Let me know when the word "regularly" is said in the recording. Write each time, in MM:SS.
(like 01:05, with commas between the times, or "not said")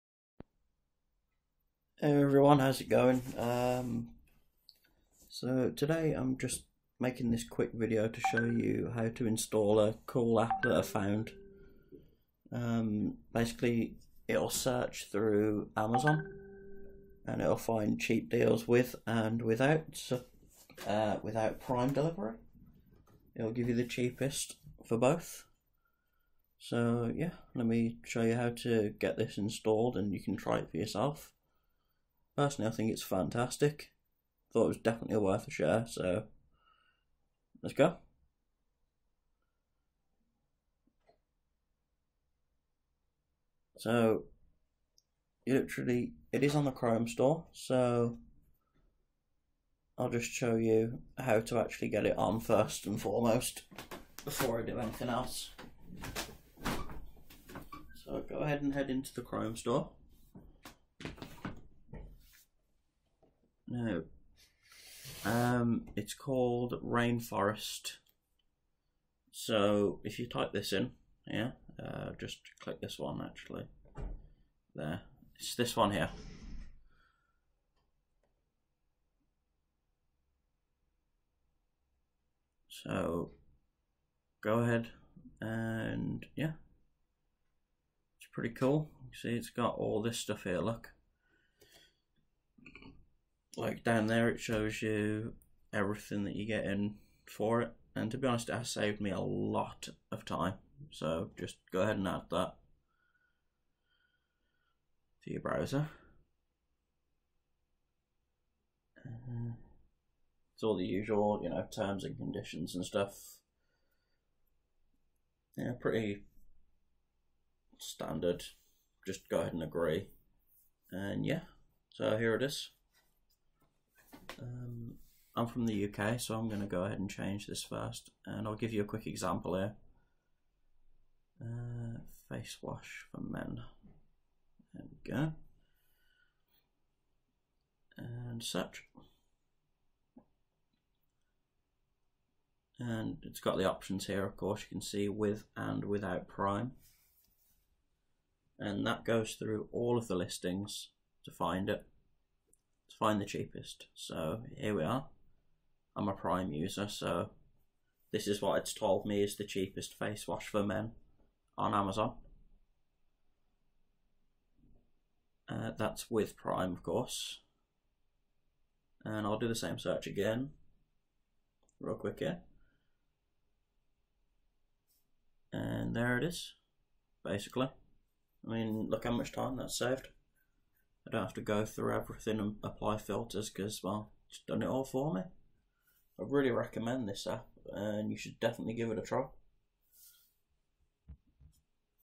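not said.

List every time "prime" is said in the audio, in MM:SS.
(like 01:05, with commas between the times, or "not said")
00:21, 02:26, 02:36, 02:46.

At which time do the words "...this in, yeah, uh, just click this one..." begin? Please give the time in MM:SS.
01:10.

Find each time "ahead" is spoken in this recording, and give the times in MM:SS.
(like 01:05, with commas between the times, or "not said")
00:58, 01:24, 01:41, 01:59, 02:06.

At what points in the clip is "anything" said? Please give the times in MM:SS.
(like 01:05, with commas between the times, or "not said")
00:54.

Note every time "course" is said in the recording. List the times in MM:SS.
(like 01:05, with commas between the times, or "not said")
02:24, 02:46.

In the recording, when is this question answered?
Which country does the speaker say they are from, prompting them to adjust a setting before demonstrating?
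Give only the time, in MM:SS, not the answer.
02:05.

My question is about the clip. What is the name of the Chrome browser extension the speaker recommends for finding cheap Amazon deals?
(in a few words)
Rainforest.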